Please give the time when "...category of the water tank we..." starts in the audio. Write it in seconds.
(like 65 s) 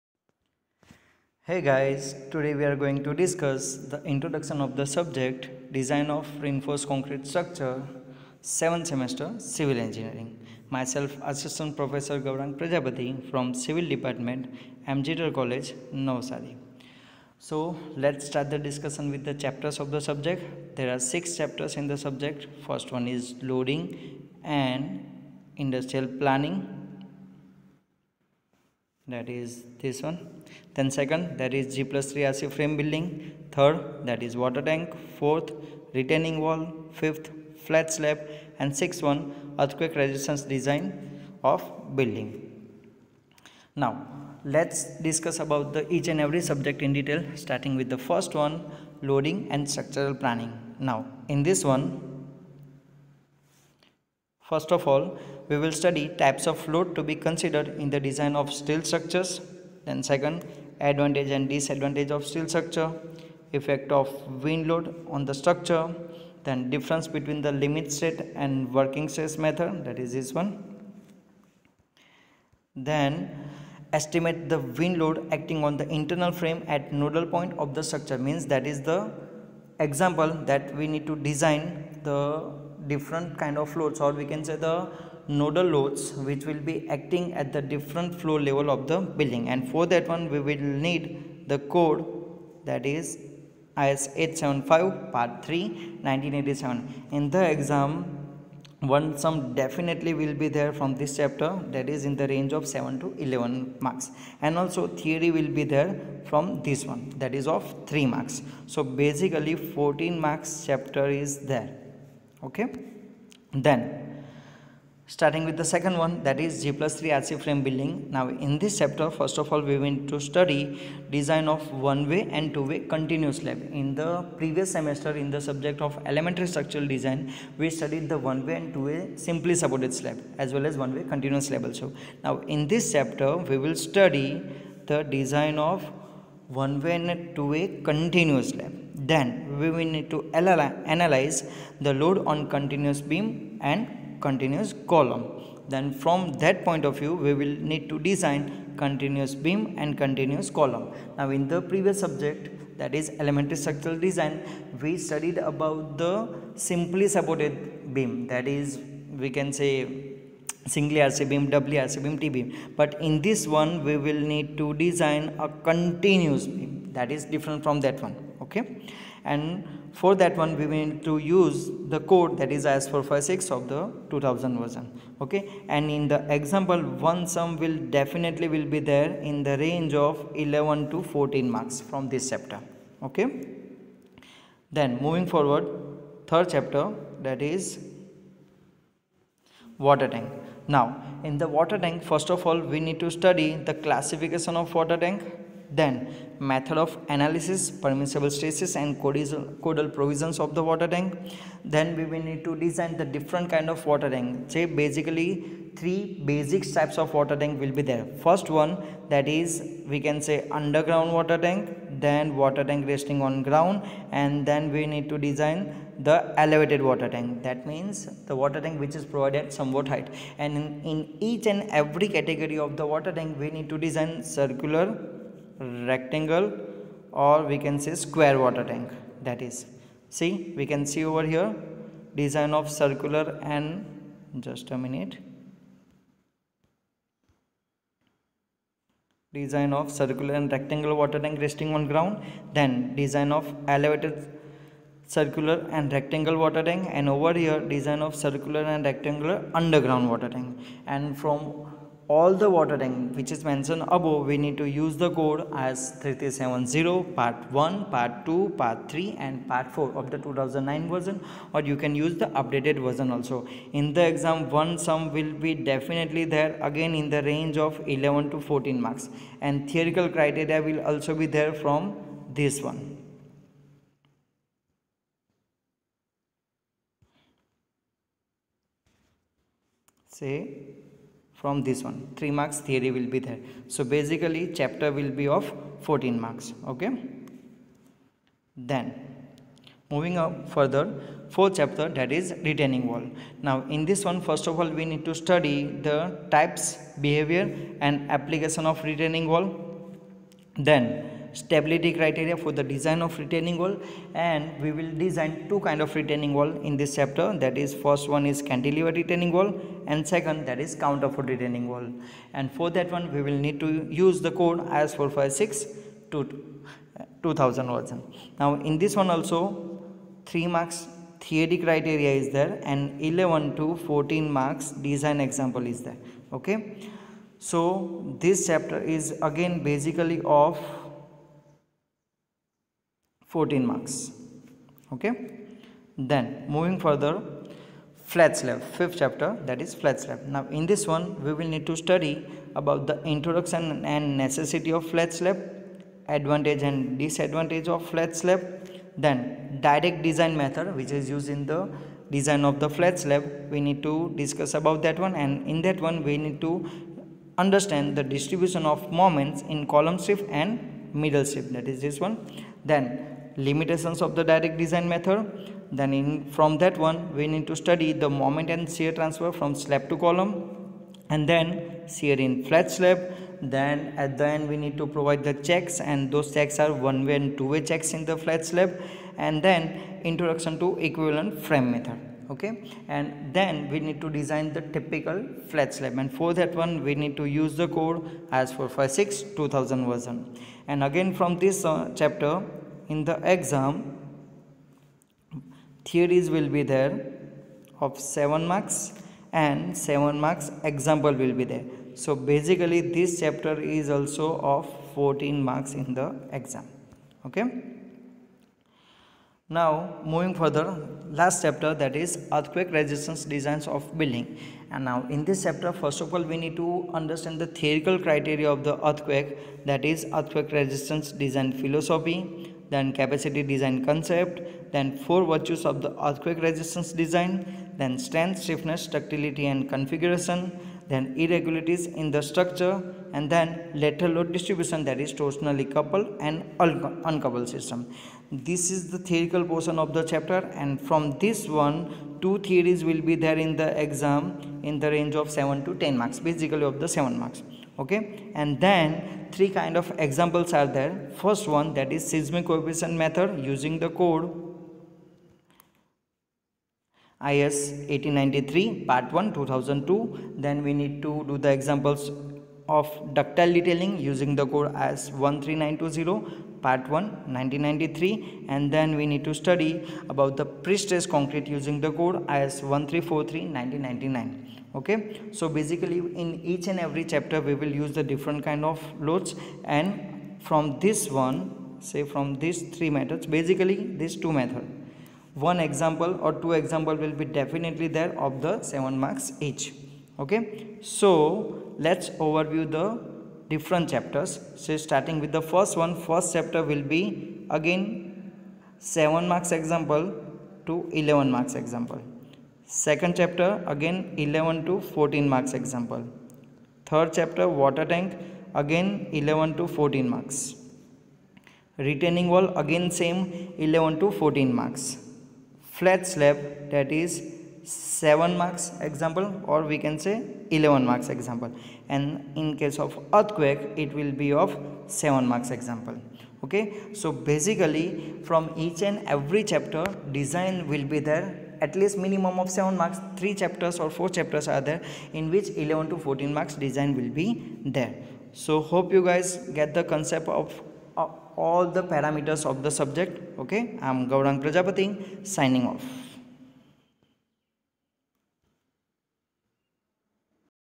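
222 s.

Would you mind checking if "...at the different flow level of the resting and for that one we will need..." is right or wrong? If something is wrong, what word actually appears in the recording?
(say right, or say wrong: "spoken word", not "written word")
wrong: "building", not "resting".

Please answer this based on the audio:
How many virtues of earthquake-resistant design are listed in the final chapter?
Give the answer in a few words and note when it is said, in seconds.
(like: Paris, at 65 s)
4, at 425 s.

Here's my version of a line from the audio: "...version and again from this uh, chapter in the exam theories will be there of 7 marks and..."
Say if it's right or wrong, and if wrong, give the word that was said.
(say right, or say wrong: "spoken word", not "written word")
right.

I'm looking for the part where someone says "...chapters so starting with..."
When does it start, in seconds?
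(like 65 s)
493 s.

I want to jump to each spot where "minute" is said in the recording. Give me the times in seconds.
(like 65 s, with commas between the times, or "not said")
234 s.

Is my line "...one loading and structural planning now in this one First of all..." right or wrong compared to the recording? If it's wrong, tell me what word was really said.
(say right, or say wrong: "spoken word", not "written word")
right.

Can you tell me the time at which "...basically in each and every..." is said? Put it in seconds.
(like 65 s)
475 s.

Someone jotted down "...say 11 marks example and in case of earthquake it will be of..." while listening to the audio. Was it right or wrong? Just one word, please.
right.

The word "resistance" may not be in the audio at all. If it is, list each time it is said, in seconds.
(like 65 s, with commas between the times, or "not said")
40 s, 412 s, 420 s, 426 s.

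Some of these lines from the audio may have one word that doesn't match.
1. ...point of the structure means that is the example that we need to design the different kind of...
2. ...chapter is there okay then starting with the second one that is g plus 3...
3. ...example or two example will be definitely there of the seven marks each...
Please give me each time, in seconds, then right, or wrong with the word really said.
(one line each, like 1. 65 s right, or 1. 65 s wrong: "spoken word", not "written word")
1. 77 s right
2. 110 s right
3. 485 s right.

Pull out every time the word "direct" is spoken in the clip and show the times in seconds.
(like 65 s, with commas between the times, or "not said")
349 s, 364 s.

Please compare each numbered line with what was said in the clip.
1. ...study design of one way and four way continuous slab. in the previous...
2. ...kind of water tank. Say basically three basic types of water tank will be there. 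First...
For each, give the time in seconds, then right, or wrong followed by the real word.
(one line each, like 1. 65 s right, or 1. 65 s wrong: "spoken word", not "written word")
1. 120 s wrong: "two", not "four"
2. 203 s right.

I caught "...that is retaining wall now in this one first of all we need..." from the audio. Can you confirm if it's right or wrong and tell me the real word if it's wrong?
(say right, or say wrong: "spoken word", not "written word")
right.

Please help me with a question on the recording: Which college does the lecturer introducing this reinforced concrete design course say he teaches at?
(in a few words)
MGTR College, Navsari.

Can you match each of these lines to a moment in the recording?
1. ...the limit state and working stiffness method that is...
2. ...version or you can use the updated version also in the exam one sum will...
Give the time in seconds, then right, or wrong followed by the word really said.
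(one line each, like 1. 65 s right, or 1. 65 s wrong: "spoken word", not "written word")
1. 67 s wrong: "stress", not "stiffness"
2. 260 s right.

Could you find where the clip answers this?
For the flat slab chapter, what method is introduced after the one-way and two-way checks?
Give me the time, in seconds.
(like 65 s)
380 s.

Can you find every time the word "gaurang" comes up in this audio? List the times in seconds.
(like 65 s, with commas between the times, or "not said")
12 s, 544 s.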